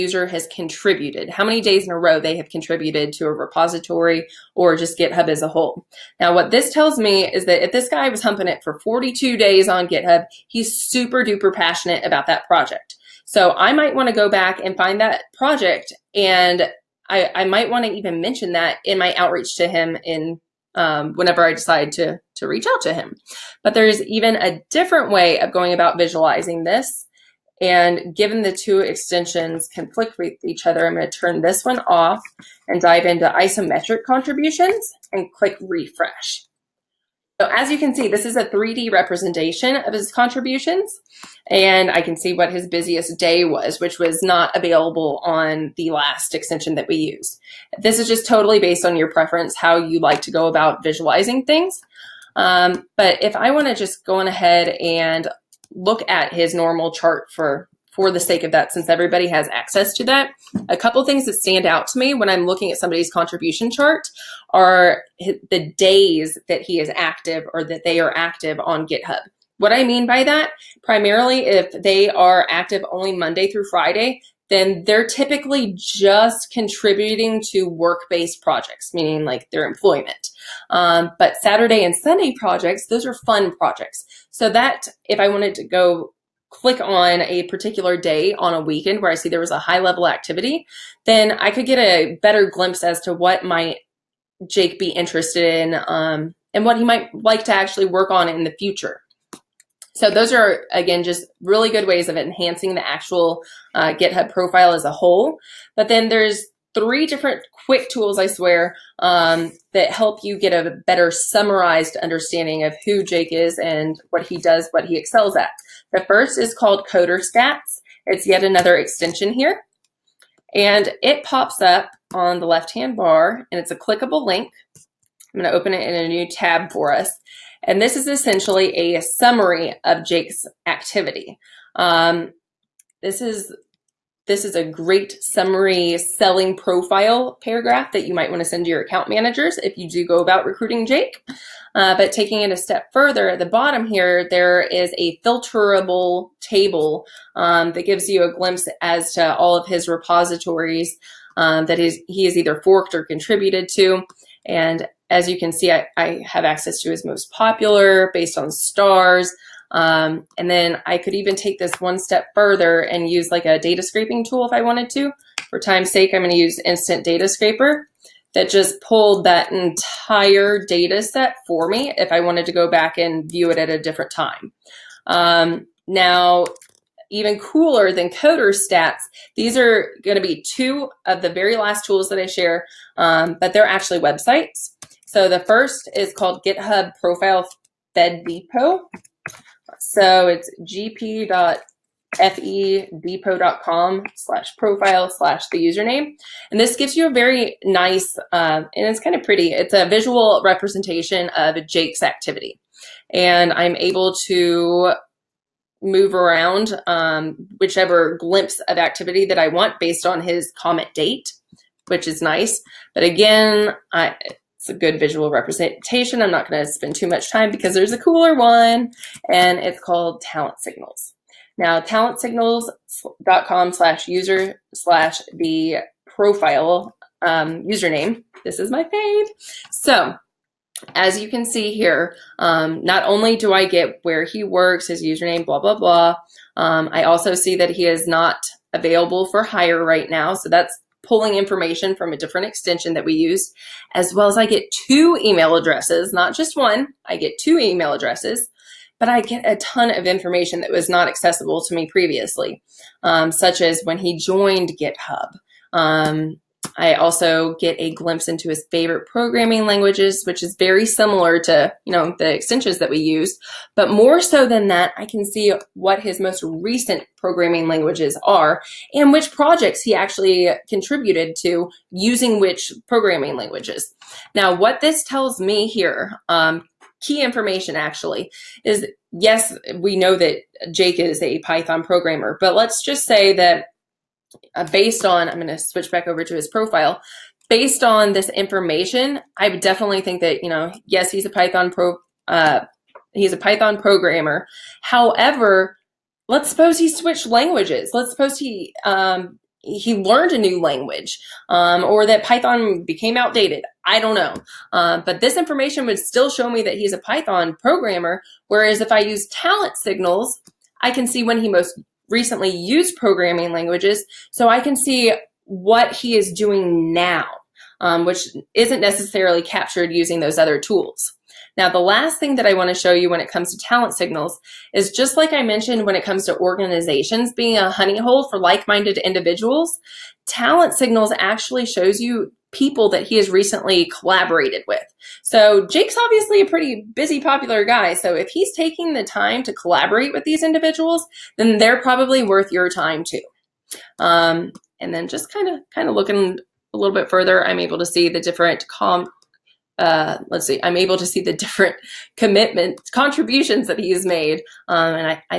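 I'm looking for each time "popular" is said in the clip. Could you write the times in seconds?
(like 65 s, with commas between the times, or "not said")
157 s, 337 s.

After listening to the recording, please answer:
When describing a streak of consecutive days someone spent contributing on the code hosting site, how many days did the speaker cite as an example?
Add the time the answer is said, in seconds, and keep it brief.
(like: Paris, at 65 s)
42, at 8 s.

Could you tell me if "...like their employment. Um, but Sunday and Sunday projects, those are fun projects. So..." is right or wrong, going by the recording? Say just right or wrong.
wrong.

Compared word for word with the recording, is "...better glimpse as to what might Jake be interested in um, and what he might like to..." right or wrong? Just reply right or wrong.
right.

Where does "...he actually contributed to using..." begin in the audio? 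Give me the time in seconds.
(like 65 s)
269 s.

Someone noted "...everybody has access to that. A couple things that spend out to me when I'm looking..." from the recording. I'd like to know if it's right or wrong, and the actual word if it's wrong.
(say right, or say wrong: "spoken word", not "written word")
wrong: "stand", not "spend".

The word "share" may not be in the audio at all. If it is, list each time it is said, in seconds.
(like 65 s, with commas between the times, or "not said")
182 s.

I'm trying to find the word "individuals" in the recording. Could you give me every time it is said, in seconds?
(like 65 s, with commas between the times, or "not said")
328 s, 340 s.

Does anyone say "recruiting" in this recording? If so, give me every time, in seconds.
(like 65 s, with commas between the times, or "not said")
140 s.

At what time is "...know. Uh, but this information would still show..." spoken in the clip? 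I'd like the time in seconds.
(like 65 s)
304 s.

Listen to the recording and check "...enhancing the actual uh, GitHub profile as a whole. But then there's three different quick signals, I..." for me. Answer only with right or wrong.
wrong.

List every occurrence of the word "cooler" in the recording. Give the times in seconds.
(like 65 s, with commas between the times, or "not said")
177 s, 217 s.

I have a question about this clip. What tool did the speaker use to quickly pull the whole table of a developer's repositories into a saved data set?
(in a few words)
Instant Data Scraper.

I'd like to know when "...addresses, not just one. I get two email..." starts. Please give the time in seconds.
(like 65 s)
245 s.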